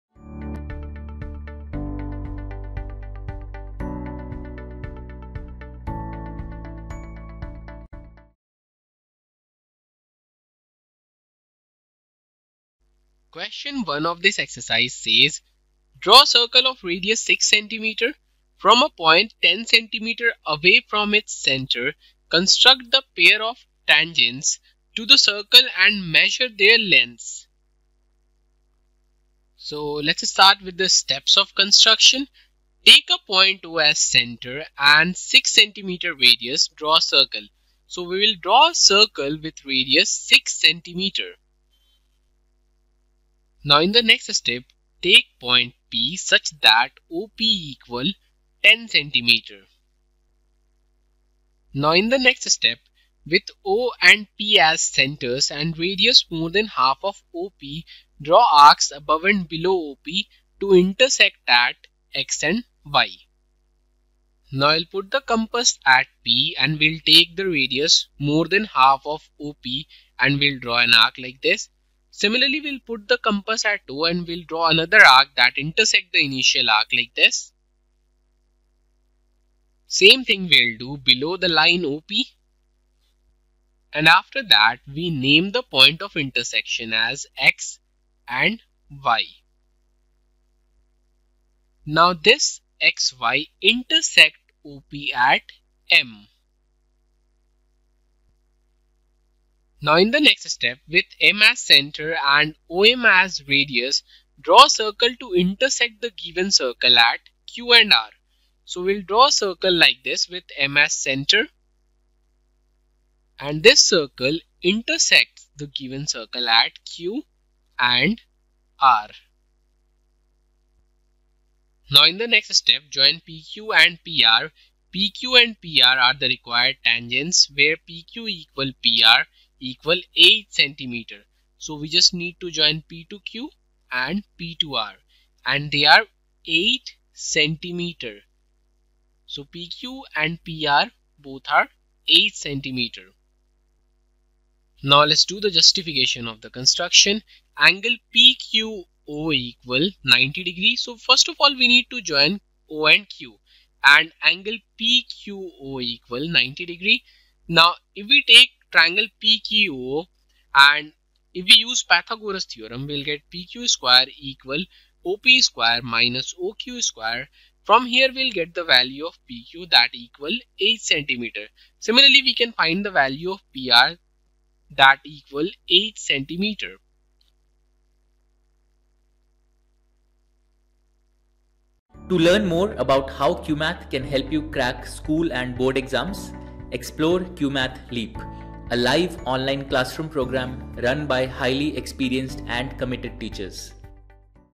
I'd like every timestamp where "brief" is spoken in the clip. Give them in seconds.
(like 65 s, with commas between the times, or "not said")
not said.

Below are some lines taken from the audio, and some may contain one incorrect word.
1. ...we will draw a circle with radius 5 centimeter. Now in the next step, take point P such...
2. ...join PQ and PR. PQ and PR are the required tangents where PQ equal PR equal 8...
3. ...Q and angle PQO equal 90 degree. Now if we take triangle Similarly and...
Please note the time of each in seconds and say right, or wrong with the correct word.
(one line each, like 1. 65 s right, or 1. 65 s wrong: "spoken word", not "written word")
1. 38 s wrong: "6", not "5"
2. 122 s right
3. 153 s wrong: "PQO", not "Similarly".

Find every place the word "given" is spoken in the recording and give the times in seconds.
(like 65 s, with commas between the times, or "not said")
106 s, 115 s.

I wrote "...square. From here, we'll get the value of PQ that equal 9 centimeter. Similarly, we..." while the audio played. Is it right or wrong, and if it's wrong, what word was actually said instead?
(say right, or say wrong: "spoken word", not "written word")
wrong: "8", not "9".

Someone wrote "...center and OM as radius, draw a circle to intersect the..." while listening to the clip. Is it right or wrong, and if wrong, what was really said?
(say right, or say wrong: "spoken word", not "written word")
right.